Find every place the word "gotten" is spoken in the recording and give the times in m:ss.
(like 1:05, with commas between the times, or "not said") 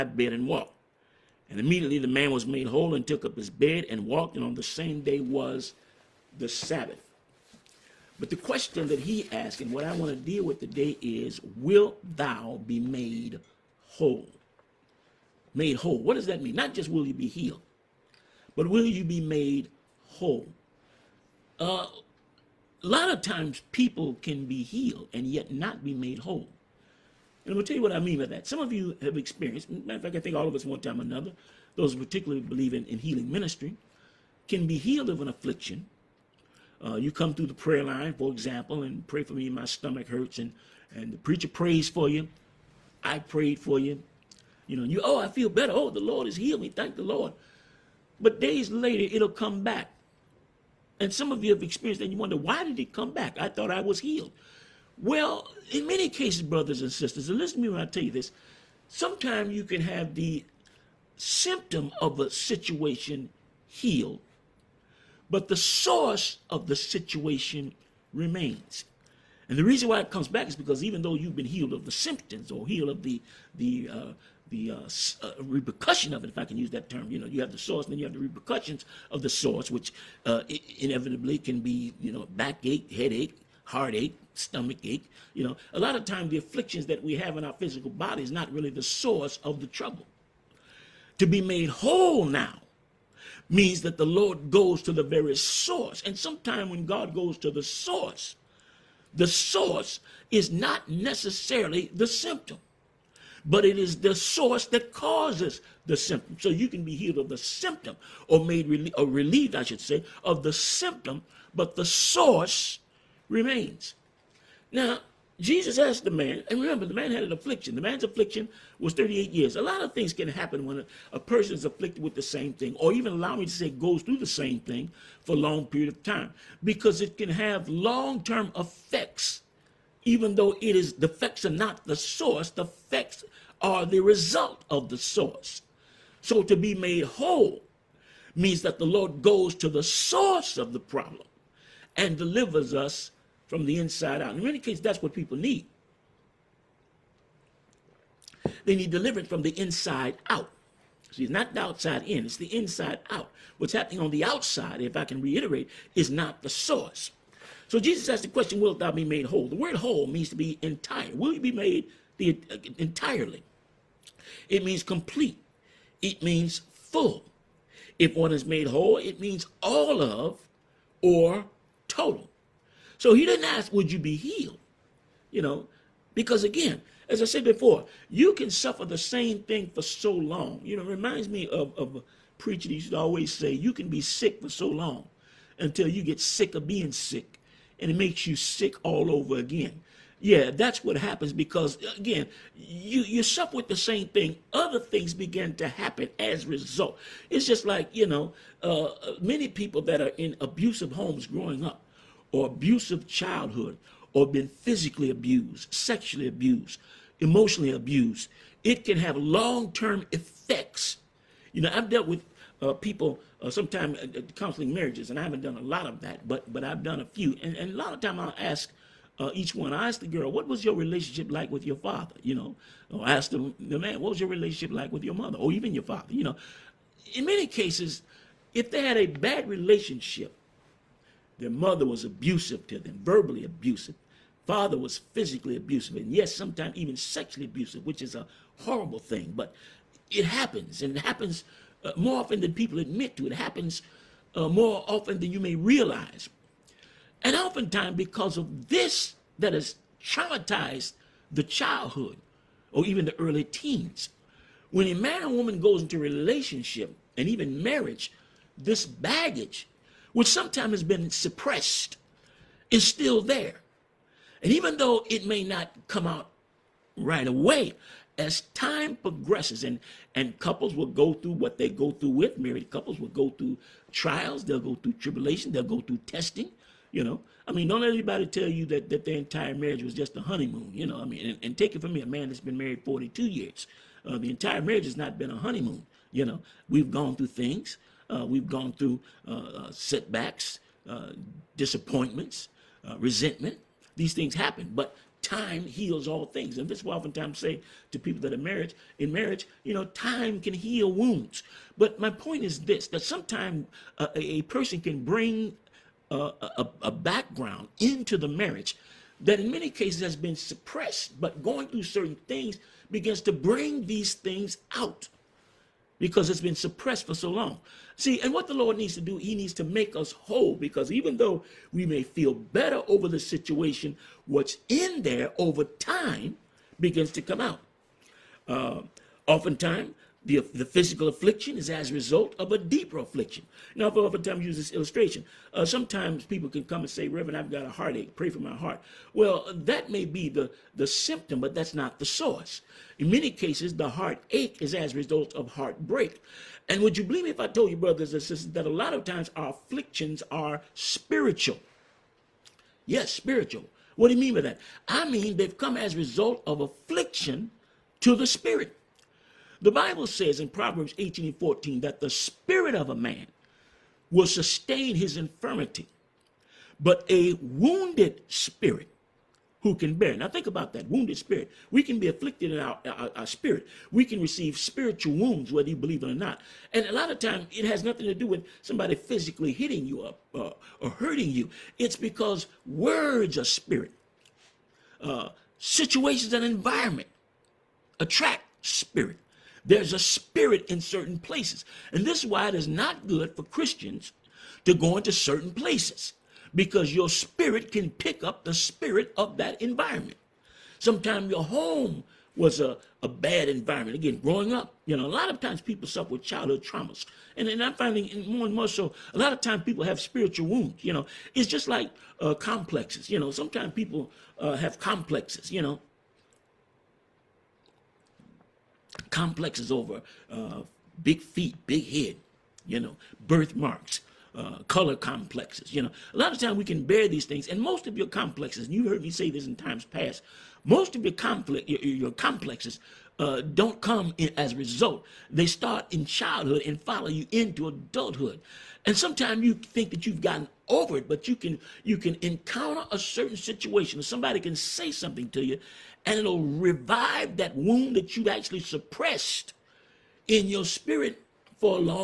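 7:20.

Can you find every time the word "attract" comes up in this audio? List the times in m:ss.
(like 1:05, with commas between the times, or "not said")
6:27.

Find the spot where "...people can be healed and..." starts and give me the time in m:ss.
0:23.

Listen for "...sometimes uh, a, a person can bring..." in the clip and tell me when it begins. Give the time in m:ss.
5:03.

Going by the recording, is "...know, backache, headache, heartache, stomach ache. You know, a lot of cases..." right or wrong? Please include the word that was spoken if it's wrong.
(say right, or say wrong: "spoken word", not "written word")
wrong: "times", not "cases".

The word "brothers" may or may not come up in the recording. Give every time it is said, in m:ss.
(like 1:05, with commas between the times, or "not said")
0:56, 5:47.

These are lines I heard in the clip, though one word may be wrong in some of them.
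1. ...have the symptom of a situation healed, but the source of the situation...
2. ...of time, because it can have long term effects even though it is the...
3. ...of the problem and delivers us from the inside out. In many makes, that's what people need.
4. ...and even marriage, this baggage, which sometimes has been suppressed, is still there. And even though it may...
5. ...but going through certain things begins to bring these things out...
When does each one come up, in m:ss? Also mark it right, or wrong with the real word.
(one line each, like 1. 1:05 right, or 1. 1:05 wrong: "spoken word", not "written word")
1. 0:59 right
2. 2:05 right
3. 2:20 wrong: "cases", not "makes"
4. 4:17 right
5. 5:11 right.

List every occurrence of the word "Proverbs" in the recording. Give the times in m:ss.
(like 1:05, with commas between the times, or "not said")
6:00.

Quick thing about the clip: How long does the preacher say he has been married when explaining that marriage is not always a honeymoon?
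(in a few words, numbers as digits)
42 years.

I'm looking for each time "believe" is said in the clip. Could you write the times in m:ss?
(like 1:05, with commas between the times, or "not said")
0:32, 5:47, 6:15.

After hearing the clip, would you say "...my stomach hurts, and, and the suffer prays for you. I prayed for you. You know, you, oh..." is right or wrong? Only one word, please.
wrong.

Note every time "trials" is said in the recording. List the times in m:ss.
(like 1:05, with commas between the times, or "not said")
4:33.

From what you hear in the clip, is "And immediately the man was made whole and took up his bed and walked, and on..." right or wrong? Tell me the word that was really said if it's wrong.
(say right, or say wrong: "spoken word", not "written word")
right.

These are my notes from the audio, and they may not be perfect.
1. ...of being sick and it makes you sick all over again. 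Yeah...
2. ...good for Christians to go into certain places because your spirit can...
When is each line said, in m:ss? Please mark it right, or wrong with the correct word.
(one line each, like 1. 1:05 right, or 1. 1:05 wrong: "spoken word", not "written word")
1. 3:06 right
2. 6:33 right.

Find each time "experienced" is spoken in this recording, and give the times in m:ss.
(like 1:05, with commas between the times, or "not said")
0:29, 0:51.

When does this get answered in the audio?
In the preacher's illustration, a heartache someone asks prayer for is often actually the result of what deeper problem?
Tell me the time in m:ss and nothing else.
5:45.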